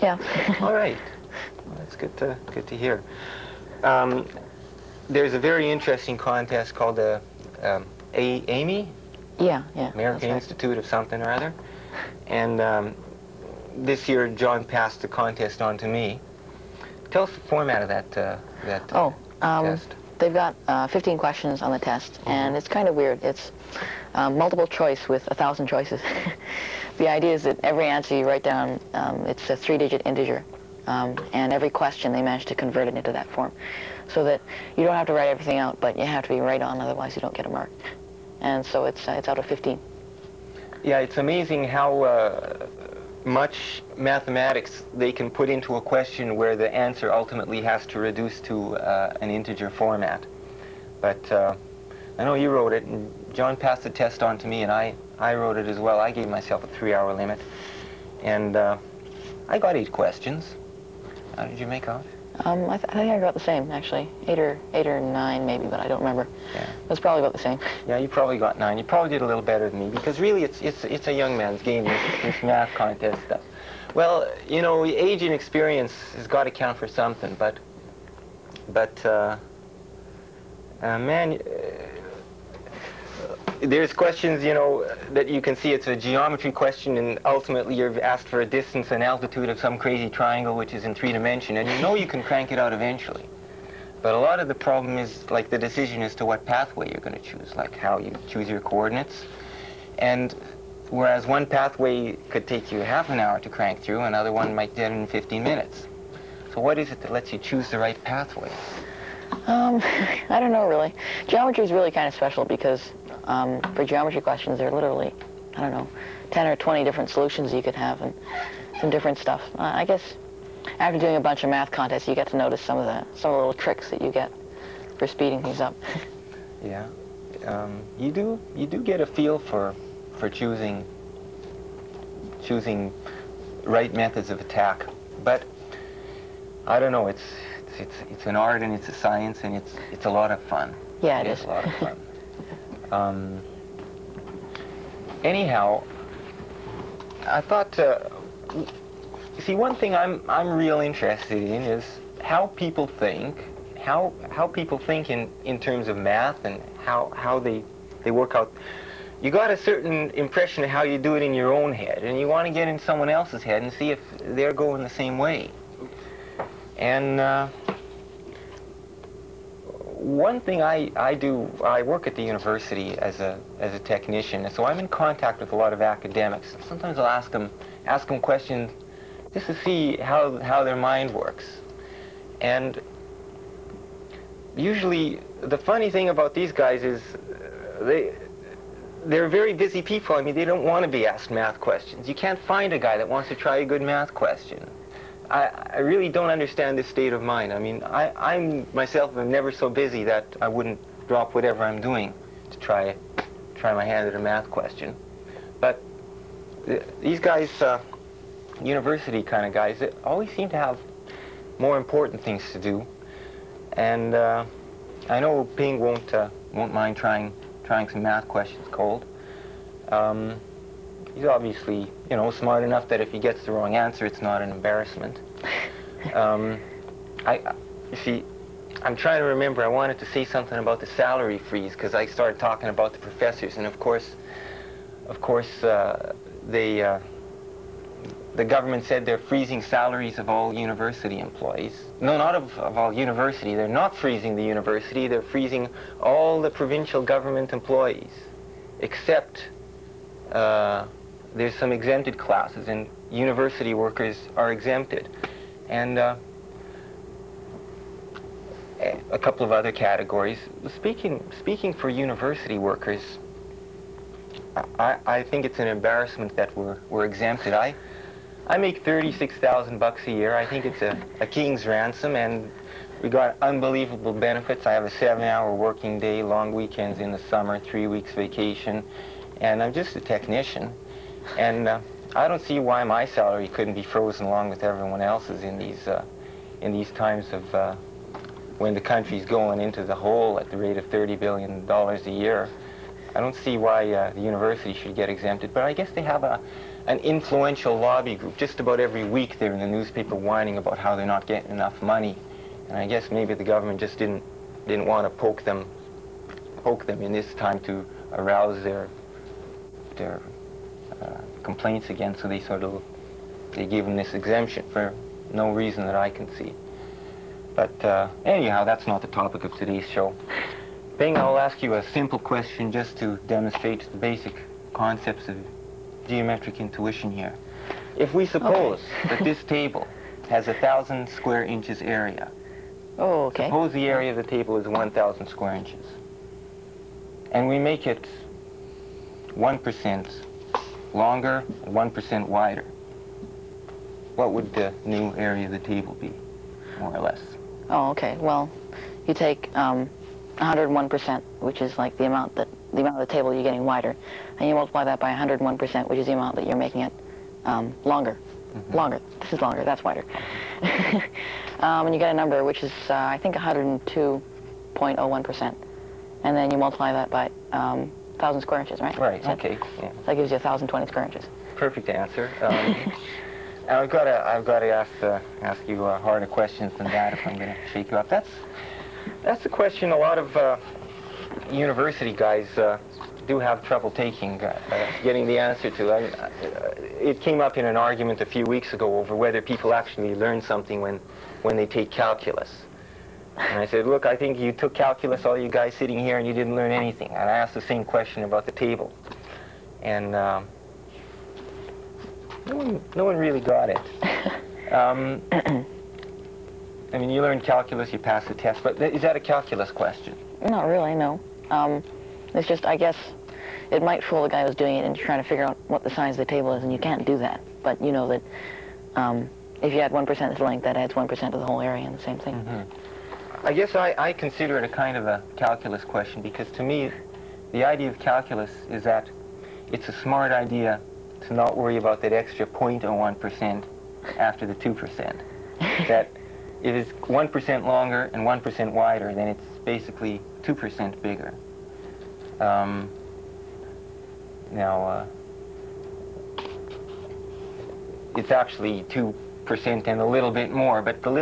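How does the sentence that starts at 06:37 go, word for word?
And I asked the same question about the table.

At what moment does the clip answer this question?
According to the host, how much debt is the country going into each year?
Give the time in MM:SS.
04:50.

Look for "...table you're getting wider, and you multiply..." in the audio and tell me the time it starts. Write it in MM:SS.
05:53.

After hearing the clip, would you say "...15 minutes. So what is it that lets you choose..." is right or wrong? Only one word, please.
right.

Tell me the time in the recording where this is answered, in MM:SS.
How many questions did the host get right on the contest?
00:59.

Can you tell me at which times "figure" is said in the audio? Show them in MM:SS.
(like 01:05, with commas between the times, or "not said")
06:55.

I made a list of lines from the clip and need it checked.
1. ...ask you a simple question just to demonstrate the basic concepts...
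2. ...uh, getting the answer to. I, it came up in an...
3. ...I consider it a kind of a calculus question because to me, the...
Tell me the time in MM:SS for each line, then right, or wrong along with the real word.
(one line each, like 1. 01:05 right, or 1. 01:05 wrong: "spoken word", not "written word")
1. 05:21 right
2. 06:24 right
3. 07:03 right.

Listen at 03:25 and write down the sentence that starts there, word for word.
But th these guys, uh, university kind of guys, they always seem to have more important things to do.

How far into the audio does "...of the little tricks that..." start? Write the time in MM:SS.
02:03.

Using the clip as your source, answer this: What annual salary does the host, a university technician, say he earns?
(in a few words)
$36,000.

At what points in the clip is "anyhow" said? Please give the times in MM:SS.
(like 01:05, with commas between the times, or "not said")
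02:25, 05:18.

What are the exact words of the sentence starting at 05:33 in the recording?
suppose the area of the table is 1,000 square inches, and we make it 1% longer, 1% wider.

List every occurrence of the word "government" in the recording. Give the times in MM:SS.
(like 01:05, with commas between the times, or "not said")
03:58, 04:07, 05:03.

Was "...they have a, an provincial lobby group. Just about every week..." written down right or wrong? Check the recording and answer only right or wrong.
wrong.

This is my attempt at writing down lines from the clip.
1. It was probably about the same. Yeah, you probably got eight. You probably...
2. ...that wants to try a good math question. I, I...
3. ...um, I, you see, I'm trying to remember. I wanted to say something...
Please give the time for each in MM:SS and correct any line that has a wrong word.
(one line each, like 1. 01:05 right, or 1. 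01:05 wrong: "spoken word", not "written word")
1. 01:06 wrong: "nine", not "eight"
2. 03:12 right
3. 03:46 right.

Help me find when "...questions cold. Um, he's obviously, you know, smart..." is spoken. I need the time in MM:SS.
03:38.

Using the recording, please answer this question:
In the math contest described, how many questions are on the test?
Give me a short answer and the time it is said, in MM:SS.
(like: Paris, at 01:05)
15, at 00:20.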